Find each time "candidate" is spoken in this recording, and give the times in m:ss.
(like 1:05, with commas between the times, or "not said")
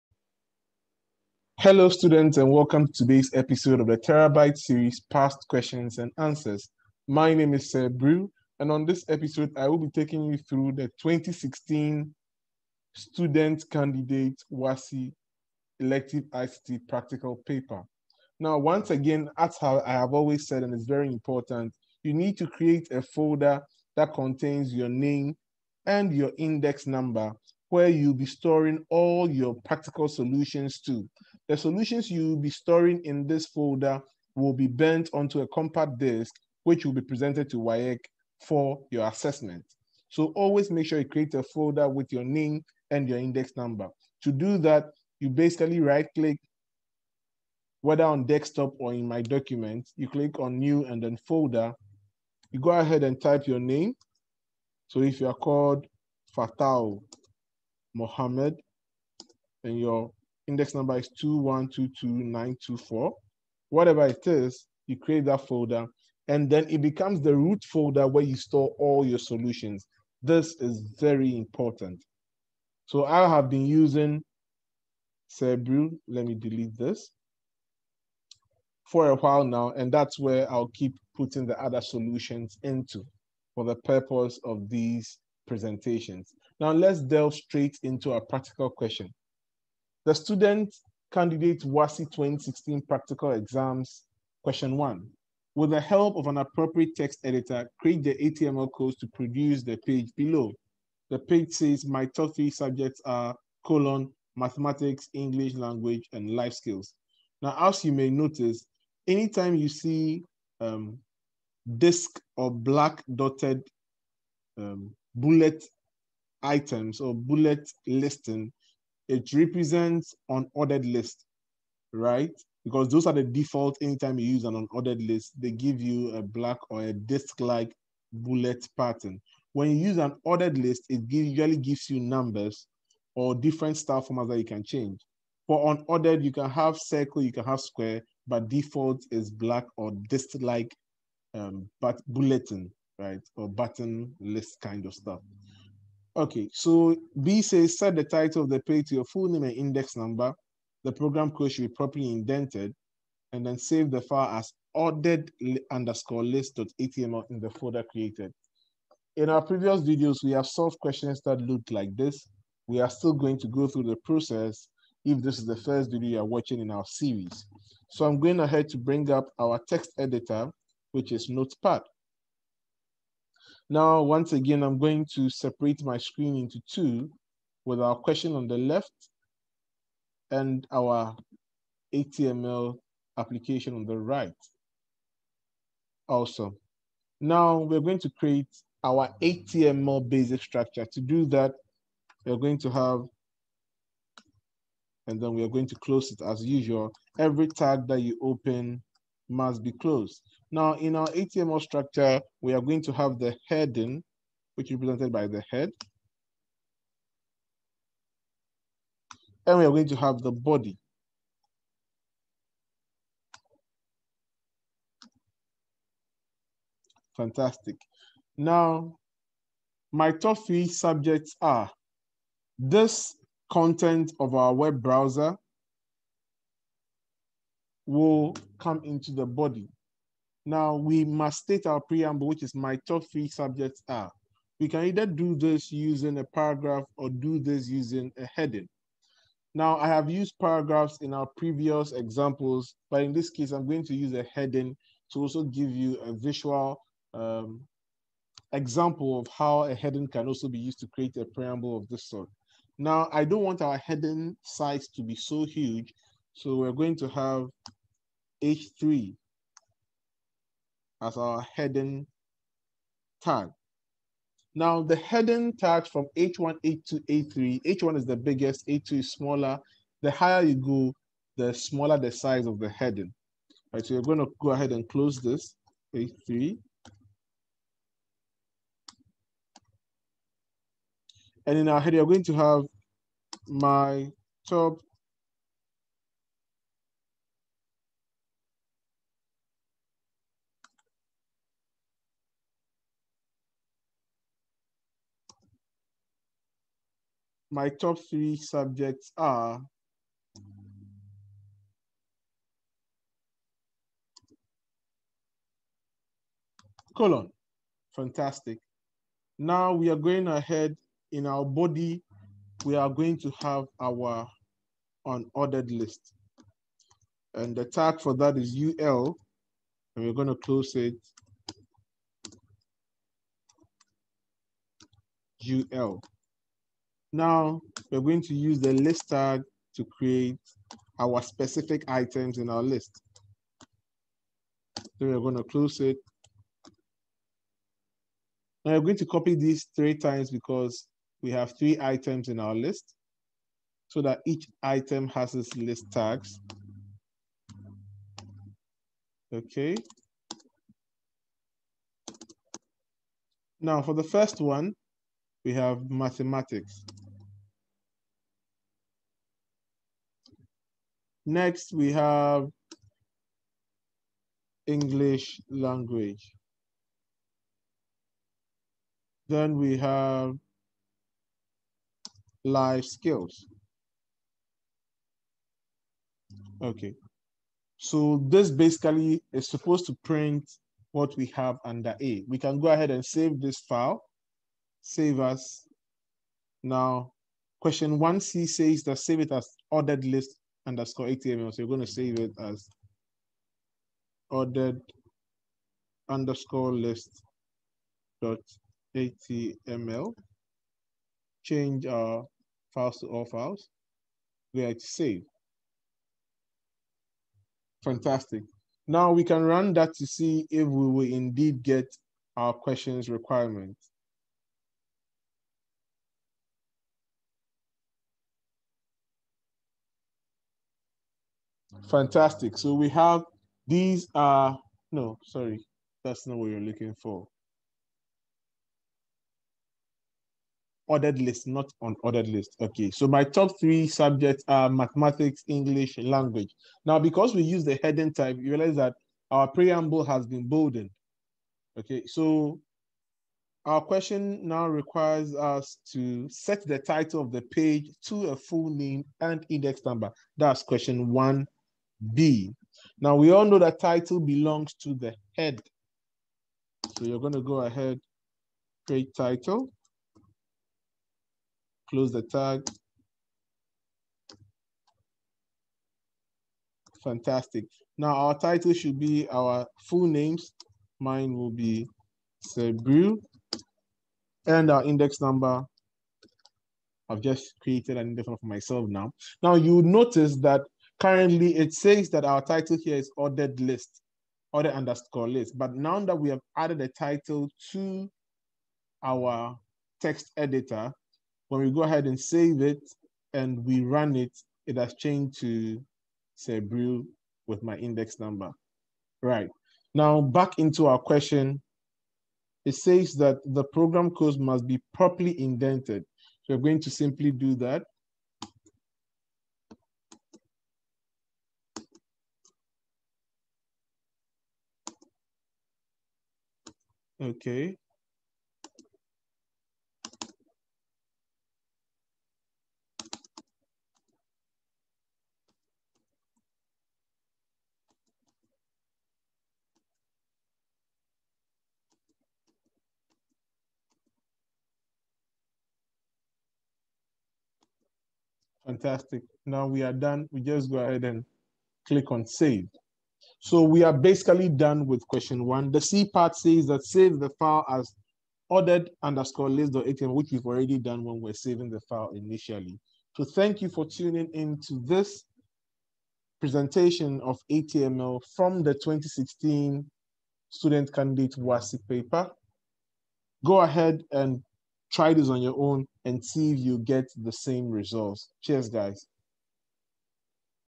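0:13, 1:31, 9:20.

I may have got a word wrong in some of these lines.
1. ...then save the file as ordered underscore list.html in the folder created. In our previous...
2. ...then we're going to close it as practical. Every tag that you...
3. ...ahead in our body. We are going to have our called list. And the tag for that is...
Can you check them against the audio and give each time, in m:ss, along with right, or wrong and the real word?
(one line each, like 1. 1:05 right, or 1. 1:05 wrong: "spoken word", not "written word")
1. 2:33 right
2. 3:15 wrong: "usual", not "practical"
3. 5:10 wrong: "unordered", not "called".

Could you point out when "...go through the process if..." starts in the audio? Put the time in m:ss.
2:43.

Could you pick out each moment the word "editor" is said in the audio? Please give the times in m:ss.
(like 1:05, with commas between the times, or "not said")
1:37, 2:49, 8:10.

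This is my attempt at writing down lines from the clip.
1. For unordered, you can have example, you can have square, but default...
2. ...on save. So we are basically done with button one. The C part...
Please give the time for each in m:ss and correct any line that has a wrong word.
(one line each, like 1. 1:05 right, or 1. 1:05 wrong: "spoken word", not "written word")
1. 2:15 wrong: "circle", not "example"
2. 9:02 wrong: "question", not "button".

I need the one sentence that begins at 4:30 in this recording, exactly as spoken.
The higher you go, the smaller the size of the heading.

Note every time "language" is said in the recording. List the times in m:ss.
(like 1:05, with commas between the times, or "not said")
1:45, 6:05, 7:15.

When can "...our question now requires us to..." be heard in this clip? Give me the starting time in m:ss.
7:23.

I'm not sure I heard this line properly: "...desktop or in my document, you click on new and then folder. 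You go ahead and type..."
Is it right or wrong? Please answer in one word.
right.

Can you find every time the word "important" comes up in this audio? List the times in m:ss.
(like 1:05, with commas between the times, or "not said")
0:21, 1:11.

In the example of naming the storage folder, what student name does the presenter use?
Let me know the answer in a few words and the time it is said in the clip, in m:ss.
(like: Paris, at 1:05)
Fatao Mohammed, at 0:56.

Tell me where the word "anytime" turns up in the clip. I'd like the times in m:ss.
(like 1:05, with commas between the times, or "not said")
1:49, 2:03.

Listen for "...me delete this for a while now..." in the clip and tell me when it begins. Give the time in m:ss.
1:16.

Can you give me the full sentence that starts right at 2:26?
Okay, so B says set the title of the page to your full name and index number.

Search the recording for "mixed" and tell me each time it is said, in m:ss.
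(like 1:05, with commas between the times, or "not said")
not said.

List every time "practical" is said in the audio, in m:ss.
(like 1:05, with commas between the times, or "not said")
0:16, 0:29, 1:28, 1:32.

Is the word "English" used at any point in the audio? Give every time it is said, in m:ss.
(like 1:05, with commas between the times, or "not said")
1:45, 6:04, 7:15.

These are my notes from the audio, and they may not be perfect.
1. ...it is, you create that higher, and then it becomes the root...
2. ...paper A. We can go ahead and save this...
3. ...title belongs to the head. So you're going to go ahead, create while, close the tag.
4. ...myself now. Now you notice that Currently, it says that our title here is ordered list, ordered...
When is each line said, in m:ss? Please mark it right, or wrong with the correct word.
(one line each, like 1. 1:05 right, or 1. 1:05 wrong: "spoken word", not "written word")
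1. 1:04 wrong: "folder", not "higher"
2. 6:21 wrong: "under", not "paper"
3. 7:33 wrong: "title", not "while"
4. 7:58 right.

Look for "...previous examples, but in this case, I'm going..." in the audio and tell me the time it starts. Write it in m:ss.
4:01.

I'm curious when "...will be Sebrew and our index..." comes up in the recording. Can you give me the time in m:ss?
7:51.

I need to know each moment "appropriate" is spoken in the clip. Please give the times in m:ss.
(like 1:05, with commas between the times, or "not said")
1:36.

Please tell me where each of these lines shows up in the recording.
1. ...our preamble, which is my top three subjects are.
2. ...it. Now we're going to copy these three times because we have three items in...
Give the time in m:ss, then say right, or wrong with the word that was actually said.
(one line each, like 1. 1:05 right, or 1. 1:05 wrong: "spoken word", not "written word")
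1. 3:51 right
2. 5:35 right.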